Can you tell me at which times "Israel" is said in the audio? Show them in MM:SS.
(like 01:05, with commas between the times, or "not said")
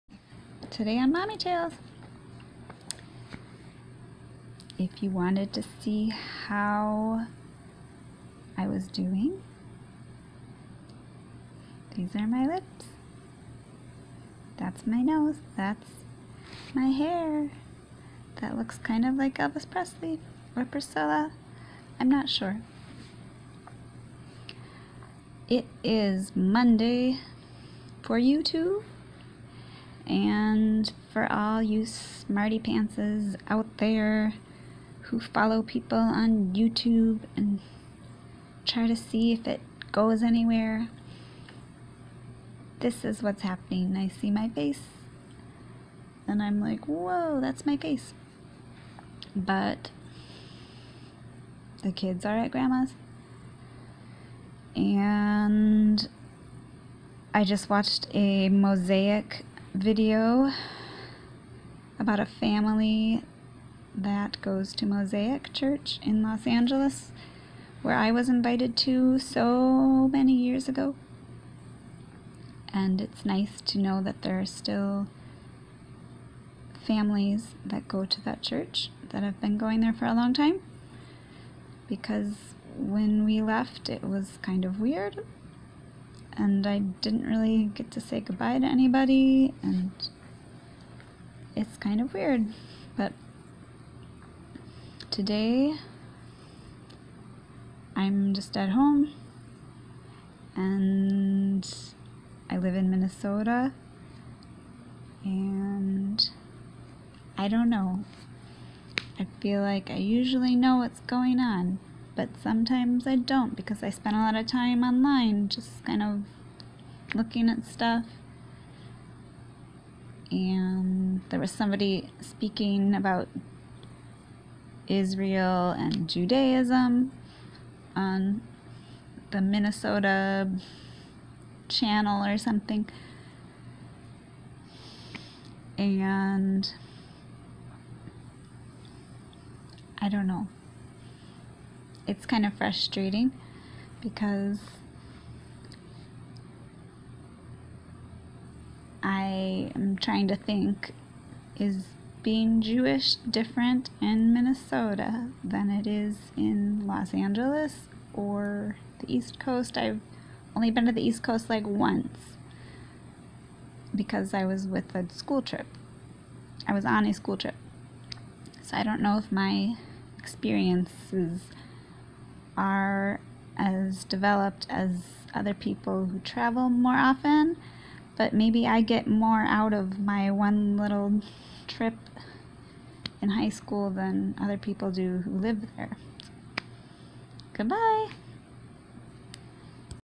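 02:04.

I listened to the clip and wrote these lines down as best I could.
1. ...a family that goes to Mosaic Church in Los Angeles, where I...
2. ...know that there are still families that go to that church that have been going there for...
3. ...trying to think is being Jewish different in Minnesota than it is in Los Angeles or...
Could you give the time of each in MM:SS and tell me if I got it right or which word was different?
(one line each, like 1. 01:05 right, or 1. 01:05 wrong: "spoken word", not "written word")
1. 01:02 right
2. 01:13 right
3. 02:29 right.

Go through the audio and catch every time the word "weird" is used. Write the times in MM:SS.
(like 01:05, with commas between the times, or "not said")
01:24, 01:32.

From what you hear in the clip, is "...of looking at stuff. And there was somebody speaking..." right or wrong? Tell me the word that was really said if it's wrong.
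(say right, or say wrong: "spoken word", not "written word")
right.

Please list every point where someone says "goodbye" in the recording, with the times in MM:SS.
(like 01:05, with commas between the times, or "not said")
01:28, 03:07.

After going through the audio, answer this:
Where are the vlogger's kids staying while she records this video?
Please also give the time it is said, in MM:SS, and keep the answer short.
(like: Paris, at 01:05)
Grandma's, at 00:52.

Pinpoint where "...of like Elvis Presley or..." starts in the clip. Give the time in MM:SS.
00:19.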